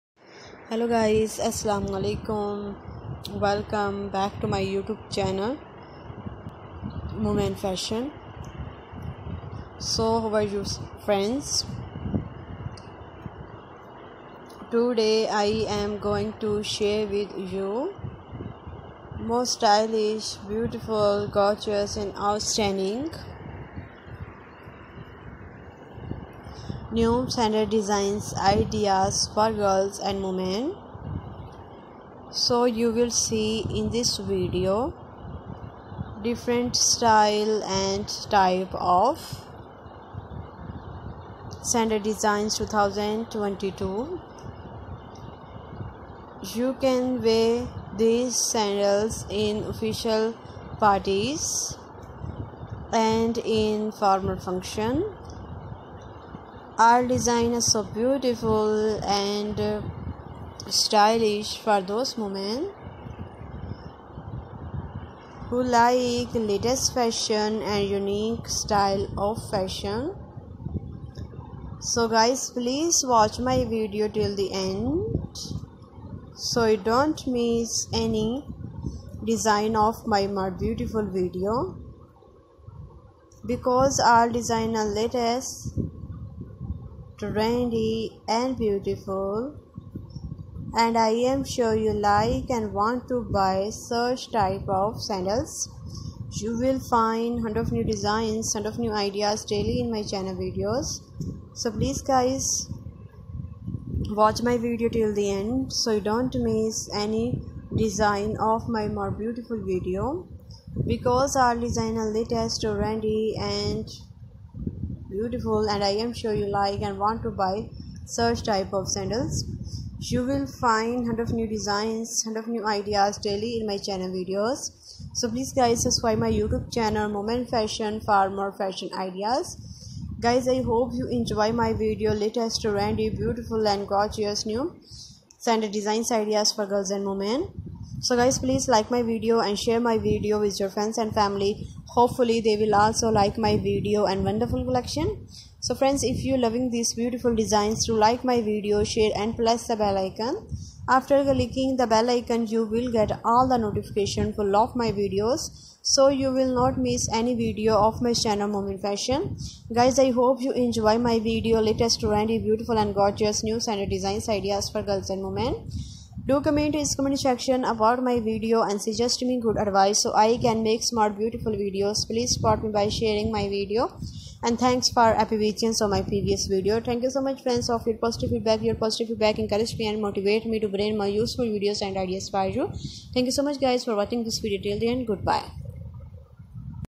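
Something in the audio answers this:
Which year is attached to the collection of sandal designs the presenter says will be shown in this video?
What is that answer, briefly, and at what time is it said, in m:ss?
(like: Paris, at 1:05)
2022, at 0:42.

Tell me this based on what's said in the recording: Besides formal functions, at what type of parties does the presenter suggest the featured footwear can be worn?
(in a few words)
Official parties.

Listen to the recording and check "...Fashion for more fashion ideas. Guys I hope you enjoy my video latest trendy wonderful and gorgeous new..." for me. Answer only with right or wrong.
wrong.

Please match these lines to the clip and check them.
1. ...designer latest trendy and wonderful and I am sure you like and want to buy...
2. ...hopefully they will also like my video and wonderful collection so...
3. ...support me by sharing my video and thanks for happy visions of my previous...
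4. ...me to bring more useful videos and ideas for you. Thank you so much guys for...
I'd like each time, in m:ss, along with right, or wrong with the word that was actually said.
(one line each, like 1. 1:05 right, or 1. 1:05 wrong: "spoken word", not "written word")
1. 1:24 wrong: "beautiful", not "wonderful"
2. 2:21 right
3. 2:52 right
4. 3:00 right.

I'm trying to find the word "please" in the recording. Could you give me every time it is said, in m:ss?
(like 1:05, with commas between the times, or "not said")
1:12, 1:41, 2:05, 2:18, 2:52.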